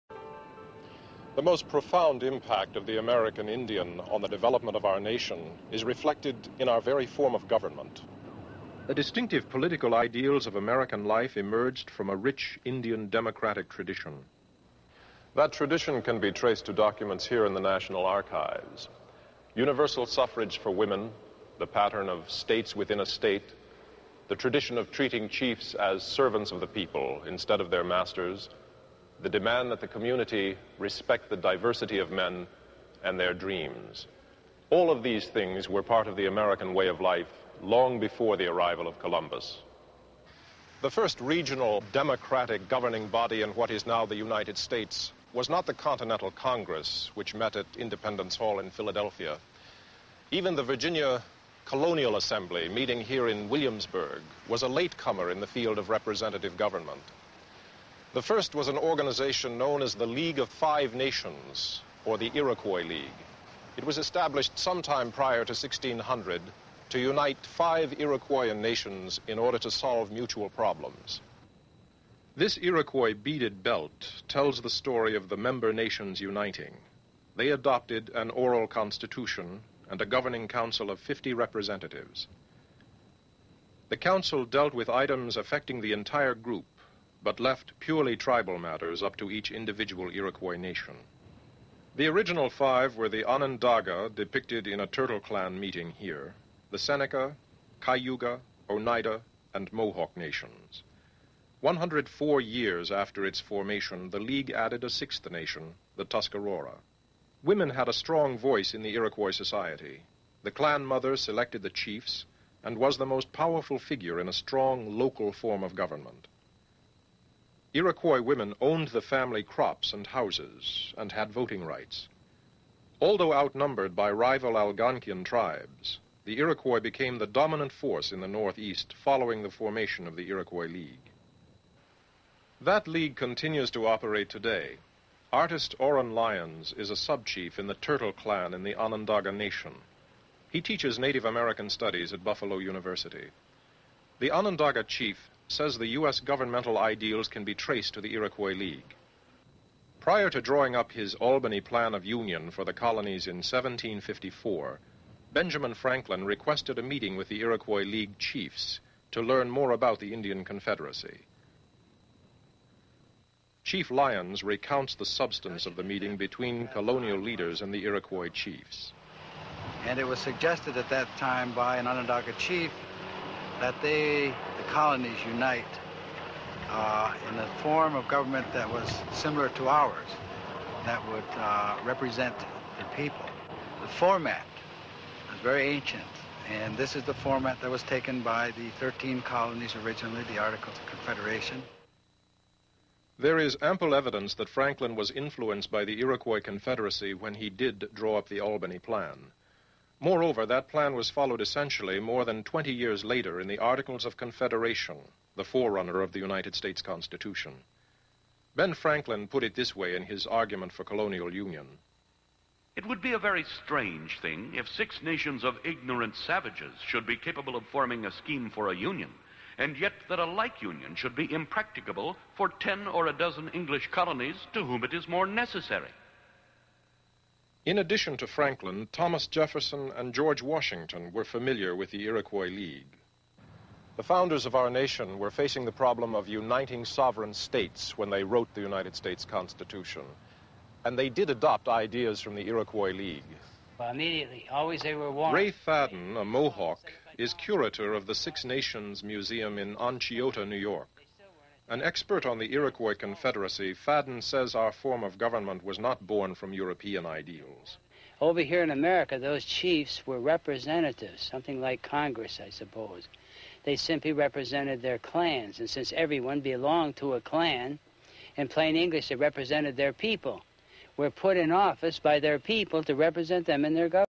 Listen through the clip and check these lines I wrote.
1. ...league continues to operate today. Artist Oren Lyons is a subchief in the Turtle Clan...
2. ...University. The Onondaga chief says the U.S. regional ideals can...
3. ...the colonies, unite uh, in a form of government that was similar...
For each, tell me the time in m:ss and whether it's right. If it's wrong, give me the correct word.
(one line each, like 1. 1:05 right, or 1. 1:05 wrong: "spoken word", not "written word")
1. 2:12 right
2. 2:22 wrong: "governmental", not "regional"
3. 2:54 right.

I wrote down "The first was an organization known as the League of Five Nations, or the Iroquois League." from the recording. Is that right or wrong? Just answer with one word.
right.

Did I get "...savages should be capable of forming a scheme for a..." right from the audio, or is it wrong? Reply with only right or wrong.
right.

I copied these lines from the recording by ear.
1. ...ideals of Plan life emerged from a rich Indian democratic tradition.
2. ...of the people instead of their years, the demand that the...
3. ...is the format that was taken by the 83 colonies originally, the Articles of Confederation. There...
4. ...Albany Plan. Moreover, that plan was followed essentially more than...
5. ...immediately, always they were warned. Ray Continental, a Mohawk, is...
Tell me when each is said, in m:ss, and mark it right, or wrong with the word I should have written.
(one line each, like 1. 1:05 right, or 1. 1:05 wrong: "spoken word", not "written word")
1. 0:09 wrong: "American", not "Plan"
2. 0:26 wrong: "masters", not "years"
3. 3:06 wrong: "13", not "83"
4. 3:18 right
5. 4:03 wrong: "Fadden", not "Continental".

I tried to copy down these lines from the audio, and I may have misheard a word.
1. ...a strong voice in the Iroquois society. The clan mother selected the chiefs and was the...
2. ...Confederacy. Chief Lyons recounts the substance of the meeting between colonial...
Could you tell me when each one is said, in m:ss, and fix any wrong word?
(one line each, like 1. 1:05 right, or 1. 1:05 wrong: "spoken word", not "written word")
1. 1:47 right
2. 2:40 right.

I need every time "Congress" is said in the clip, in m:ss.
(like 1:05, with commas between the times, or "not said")
0:46, 4:21.